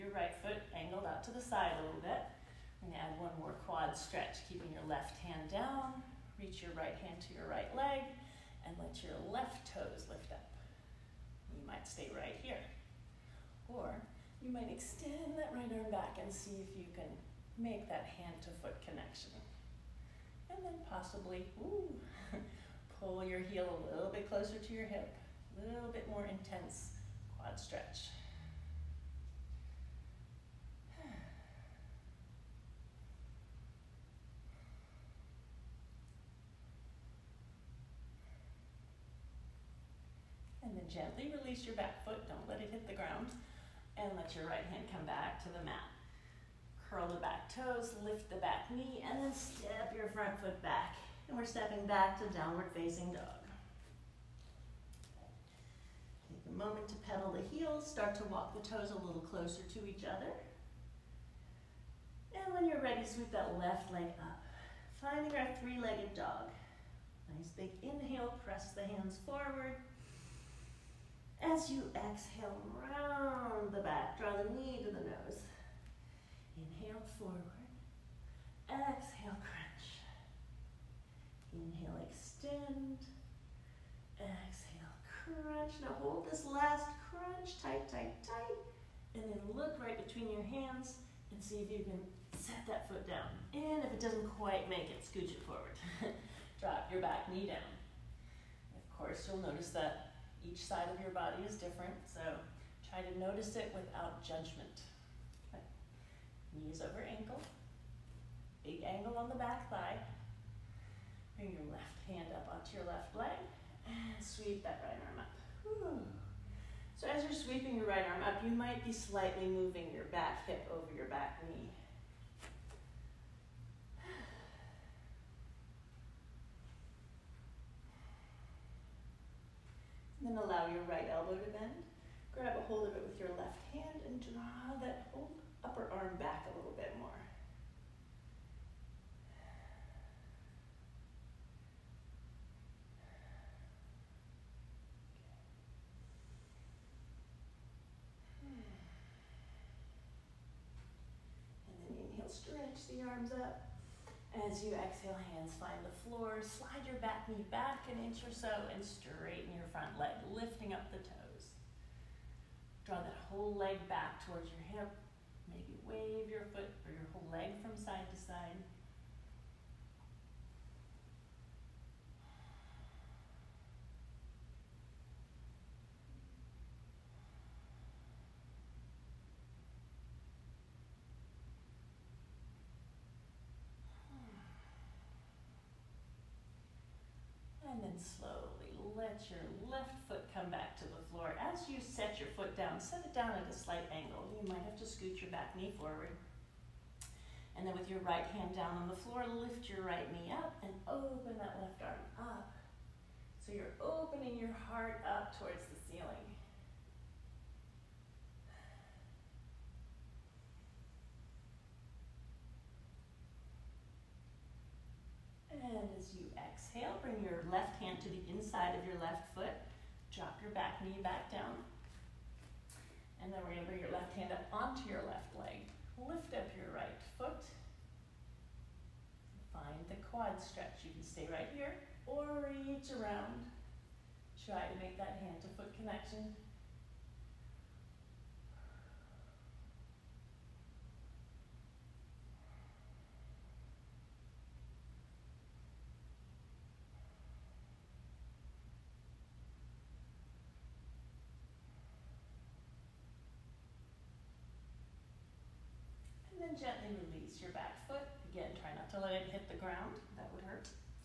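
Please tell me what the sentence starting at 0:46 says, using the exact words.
Curl the back toes, lift the back knee, and then step your front foot back.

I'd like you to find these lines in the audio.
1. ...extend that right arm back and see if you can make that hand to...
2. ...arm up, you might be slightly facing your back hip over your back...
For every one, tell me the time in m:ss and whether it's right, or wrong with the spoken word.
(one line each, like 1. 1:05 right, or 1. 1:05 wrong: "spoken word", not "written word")
1. 0:14 right
2. 1:58 wrong: "moving", not "facing".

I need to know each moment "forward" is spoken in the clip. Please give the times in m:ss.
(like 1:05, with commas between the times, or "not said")
1:09, 1:17, 1:35, 3:15.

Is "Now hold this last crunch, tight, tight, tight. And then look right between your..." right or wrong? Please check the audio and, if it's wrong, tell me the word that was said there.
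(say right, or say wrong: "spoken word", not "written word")
right.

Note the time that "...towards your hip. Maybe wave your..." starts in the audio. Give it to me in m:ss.
2:44.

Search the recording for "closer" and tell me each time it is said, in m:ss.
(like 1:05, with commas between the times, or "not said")
0:24, 0:59.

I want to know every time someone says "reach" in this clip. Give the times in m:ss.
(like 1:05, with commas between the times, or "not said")
0:06, 3:52.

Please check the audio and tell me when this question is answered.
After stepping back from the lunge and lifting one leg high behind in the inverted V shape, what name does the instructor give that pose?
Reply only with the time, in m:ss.
1:05.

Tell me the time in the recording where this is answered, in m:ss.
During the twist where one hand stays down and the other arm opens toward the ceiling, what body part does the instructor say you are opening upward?
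3:24.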